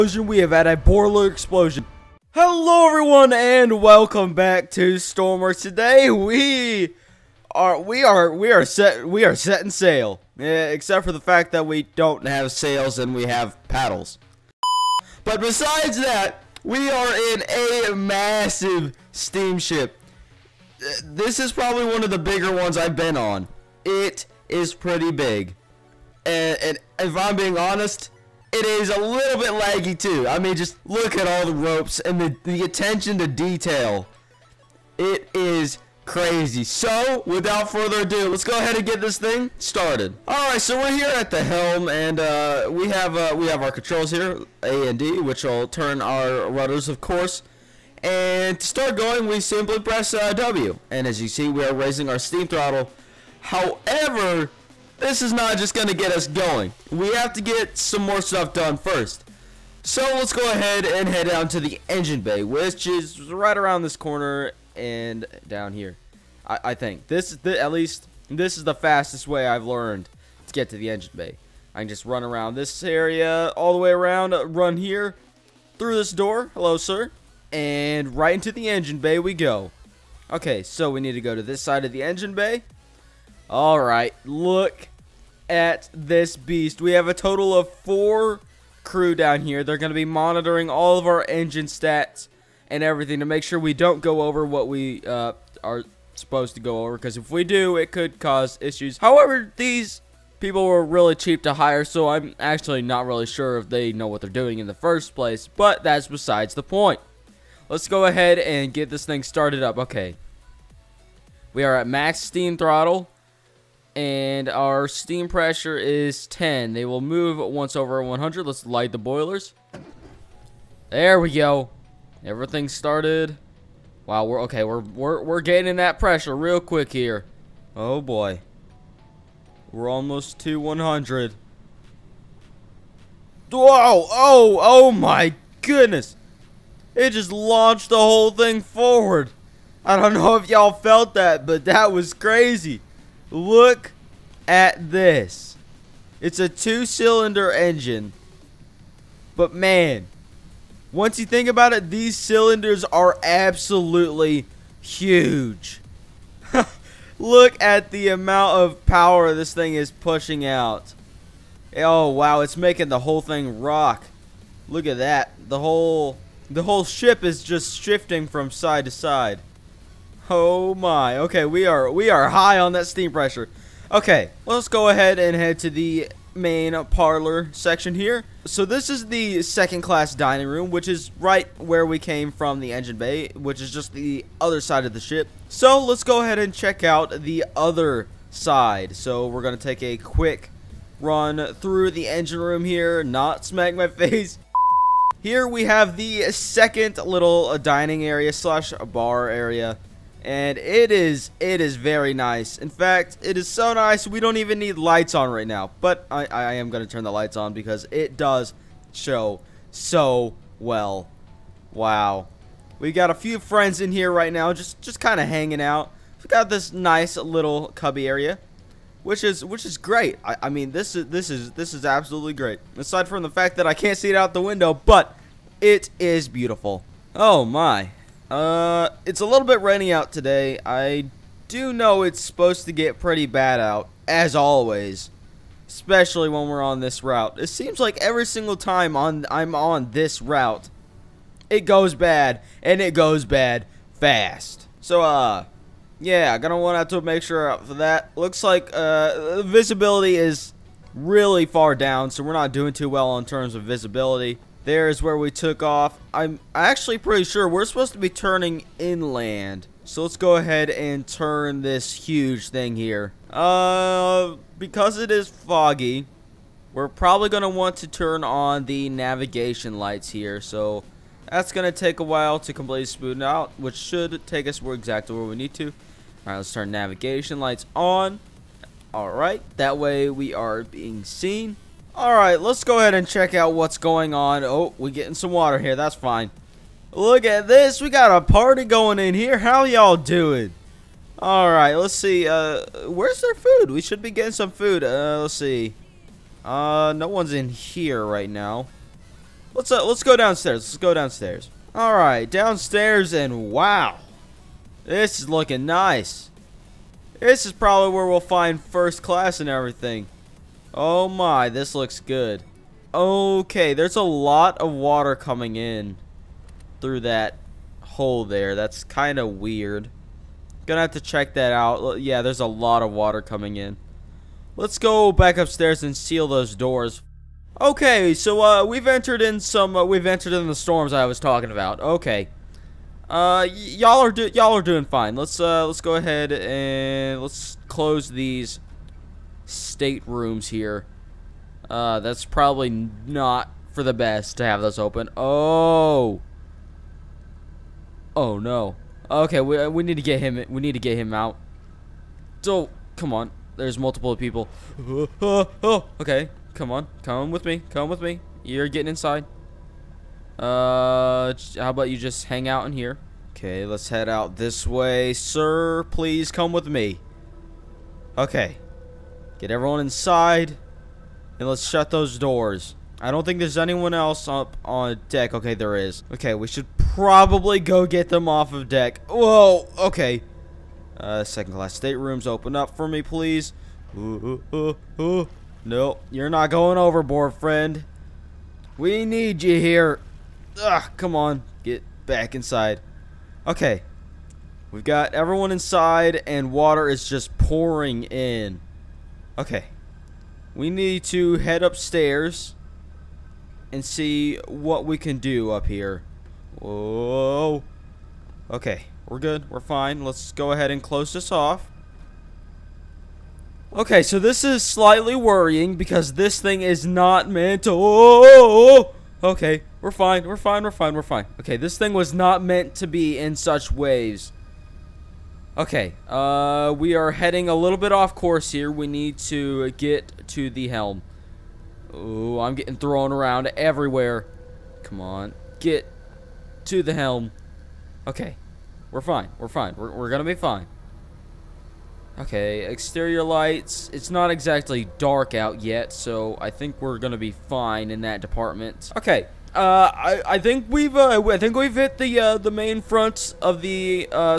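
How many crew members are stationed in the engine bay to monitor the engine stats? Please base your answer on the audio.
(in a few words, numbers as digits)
4.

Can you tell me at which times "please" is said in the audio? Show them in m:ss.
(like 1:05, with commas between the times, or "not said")
6:05, 6:23.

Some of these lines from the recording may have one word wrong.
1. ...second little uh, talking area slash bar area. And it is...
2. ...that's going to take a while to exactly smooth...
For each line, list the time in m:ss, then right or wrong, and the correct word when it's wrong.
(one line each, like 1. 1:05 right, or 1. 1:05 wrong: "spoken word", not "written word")
1. 3:16 wrong: "dining", not "talking"
2. 4:31 wrong: "completely", not "exactly".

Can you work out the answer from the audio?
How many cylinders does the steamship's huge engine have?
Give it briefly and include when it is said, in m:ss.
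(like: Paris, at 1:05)
2, at 2:26.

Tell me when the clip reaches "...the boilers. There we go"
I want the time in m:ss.
1:58.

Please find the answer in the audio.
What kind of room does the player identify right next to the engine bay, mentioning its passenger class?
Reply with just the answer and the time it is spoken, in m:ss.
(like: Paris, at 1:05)
Second class dining room, at 2:59.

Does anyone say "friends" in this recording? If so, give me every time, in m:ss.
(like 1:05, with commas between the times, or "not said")
3:33, 6:27.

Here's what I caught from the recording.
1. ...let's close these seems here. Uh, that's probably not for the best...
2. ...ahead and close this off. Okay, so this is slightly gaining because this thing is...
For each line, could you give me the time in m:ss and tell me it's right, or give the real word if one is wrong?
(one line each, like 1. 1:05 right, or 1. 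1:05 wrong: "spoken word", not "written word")
1. 5:37 wrong: "staterooms", not "seems"
2. 6:50 wrong: "worrying", not "gaining".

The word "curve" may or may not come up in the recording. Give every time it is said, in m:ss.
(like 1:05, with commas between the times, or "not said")
not said.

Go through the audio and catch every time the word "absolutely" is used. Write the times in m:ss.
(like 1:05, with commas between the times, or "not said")
2:33, 3:41.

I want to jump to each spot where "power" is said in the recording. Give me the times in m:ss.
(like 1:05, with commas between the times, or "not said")
2:38.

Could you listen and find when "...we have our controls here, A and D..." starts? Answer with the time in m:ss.
0:43.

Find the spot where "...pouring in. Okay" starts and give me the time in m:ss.
6:37.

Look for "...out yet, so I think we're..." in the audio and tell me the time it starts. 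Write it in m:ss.
7:25.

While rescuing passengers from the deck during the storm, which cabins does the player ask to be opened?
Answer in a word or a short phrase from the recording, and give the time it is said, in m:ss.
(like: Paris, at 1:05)
Second class staterooms, at 6:21.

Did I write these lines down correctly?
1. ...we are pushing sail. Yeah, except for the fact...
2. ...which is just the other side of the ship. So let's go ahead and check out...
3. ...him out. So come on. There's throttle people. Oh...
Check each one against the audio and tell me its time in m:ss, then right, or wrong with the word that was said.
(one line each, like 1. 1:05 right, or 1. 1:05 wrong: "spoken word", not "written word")
1. 0:09 wrong: "setting", not "pushing"
2. 3:03 right
3. 5:50 wrong: "multiple", not "throttle".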